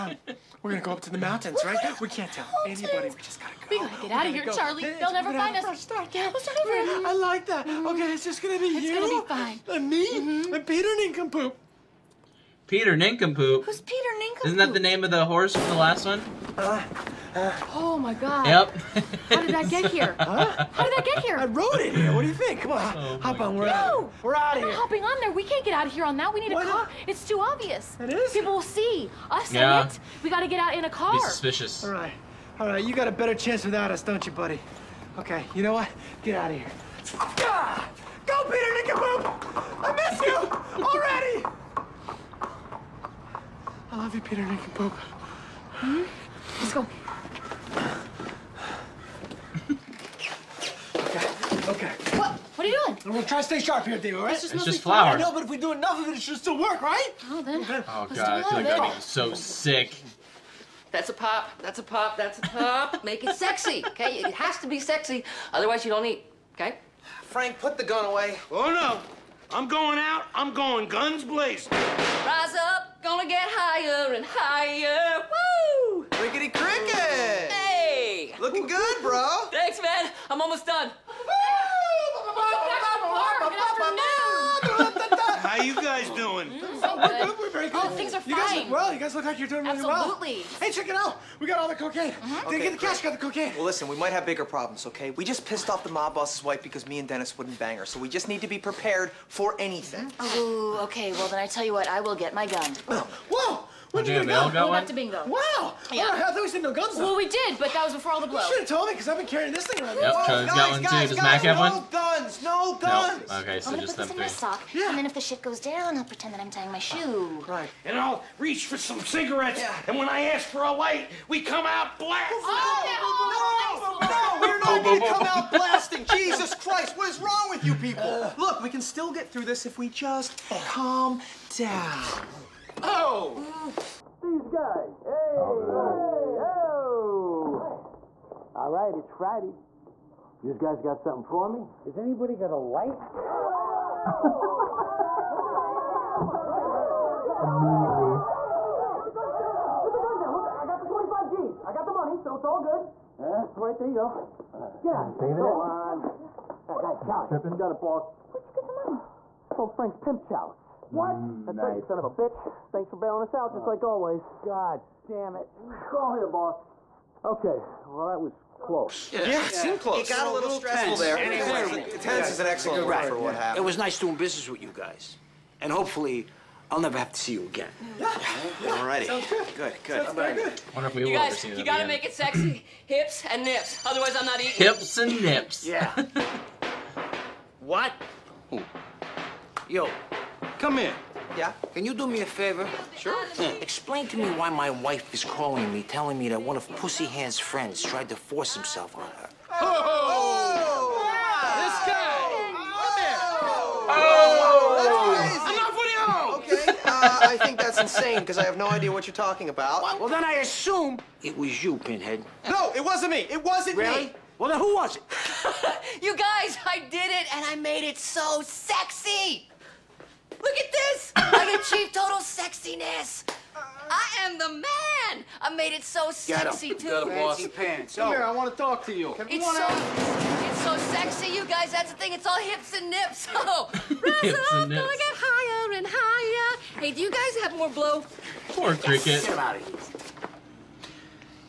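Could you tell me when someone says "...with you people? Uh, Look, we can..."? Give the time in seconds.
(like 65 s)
127 s.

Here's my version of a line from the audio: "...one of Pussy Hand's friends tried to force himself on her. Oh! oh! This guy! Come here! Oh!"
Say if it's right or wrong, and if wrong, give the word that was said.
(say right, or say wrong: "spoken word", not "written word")
right.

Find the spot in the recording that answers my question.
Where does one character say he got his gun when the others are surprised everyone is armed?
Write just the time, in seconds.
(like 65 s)
104 s.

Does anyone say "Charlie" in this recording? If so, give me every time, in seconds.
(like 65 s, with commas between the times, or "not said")
4 s, 110 s.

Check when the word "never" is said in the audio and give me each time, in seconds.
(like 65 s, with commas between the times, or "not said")
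5 s, 176 s.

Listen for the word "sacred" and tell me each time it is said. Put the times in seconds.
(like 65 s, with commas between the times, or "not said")
not said.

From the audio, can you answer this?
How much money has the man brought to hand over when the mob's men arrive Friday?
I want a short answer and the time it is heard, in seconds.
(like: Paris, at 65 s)
25 G's, at 150 s.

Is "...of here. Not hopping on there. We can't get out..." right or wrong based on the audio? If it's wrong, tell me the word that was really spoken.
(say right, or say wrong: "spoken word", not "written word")
right.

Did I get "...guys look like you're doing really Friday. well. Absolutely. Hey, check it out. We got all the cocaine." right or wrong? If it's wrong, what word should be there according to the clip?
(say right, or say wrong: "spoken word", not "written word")
wrong: "Absolutely", not "Friday".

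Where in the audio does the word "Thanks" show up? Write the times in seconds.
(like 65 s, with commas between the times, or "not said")
79 s, 162 s.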